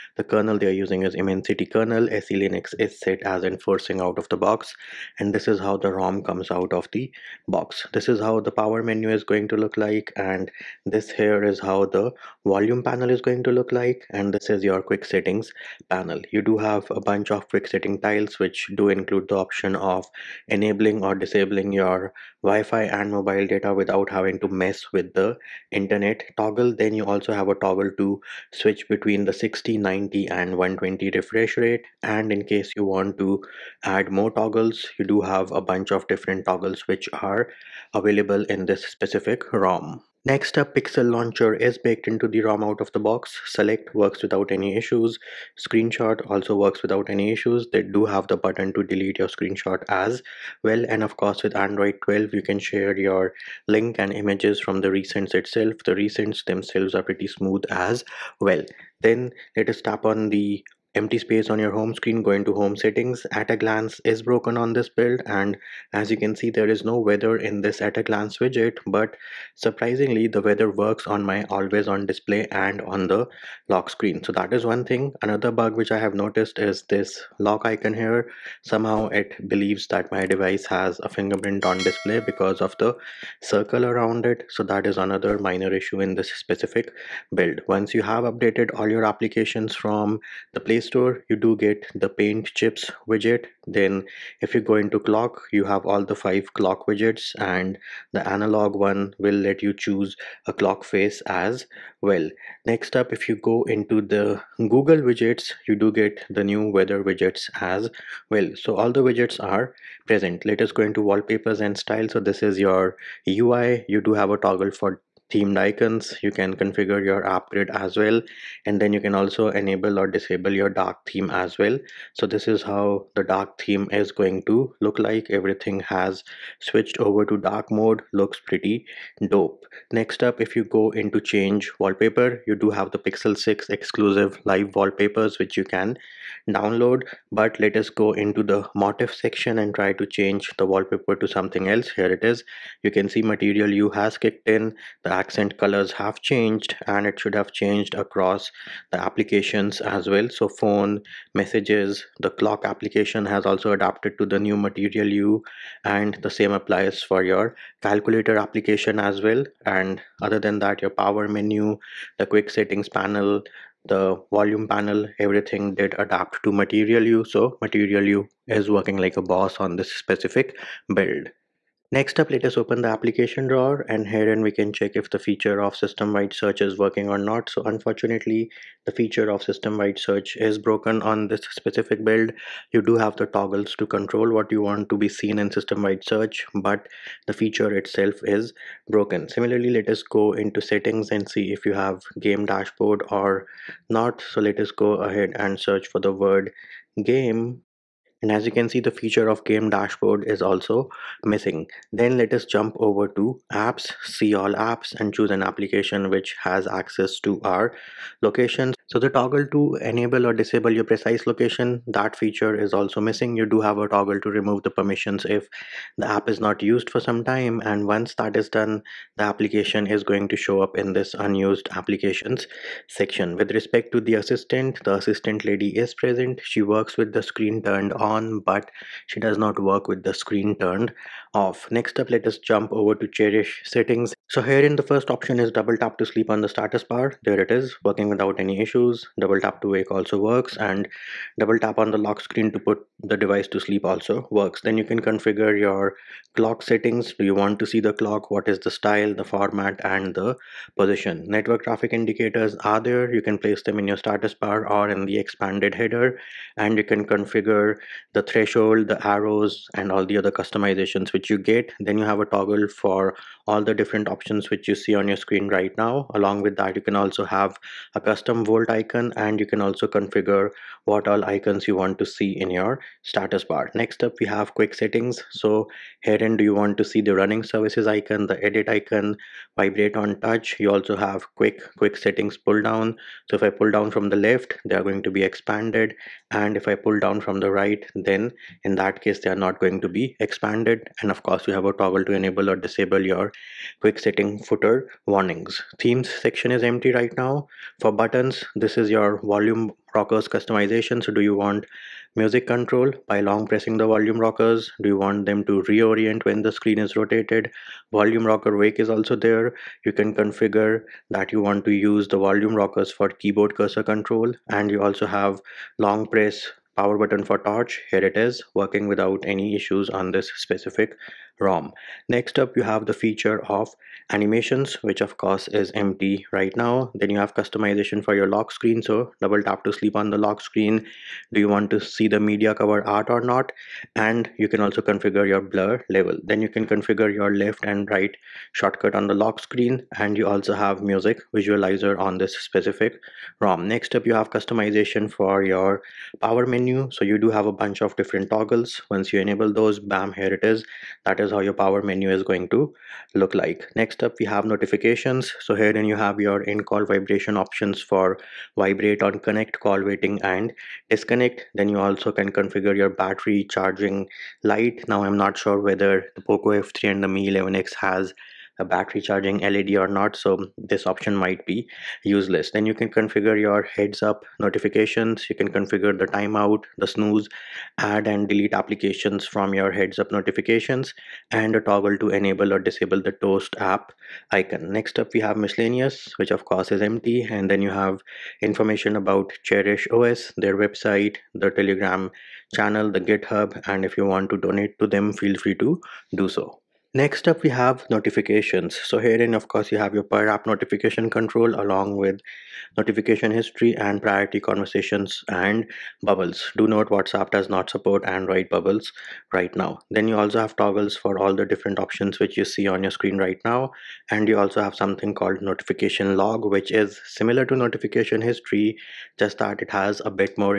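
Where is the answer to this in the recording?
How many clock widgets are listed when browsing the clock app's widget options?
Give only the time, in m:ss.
1:36.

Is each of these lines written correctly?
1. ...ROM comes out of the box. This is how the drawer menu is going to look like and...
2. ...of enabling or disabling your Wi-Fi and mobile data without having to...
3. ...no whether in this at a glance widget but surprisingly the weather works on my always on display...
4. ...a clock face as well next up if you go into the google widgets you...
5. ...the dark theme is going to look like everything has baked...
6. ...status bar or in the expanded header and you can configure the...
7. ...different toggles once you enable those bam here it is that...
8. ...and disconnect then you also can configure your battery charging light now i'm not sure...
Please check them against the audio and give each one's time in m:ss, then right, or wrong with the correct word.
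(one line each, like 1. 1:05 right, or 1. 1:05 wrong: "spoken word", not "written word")
1. 0:05 wrong: "power", not "drawer"
2. 0:19 right
3. 1:06 wrong: "weather", not "whether"
4. 1:40 right
5. 2:03 wrong: "switched", not "baked"
6. 4:13 right
7. 5:47 right
8. 6:00 right.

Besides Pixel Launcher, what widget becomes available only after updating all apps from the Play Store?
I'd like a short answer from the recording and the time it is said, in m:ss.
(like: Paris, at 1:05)
paint chips widget, at 1:32.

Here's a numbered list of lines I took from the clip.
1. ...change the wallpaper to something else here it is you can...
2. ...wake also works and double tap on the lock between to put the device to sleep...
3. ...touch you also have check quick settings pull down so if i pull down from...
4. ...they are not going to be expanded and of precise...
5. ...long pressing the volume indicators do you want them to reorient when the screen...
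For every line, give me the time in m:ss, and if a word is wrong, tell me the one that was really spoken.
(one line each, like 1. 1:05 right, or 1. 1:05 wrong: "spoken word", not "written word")
1. 2:20 right
2. 3:59 wrong: "screen", not "between"
3. 4:40 wrong: "quick", not "check"
4. 4:49 wrong: "course", not "precise"
5. 5:03 wrong: "rockers", not "indicators".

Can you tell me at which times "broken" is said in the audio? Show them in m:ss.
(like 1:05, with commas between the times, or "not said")
1:04, 3:00, 3:08.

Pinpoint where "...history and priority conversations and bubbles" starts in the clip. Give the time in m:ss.
6:43.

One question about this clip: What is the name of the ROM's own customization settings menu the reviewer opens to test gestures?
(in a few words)
Cherish settings.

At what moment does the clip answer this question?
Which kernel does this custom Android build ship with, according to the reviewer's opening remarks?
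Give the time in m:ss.
0:01.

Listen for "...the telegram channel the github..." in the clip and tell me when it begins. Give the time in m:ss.
6:31.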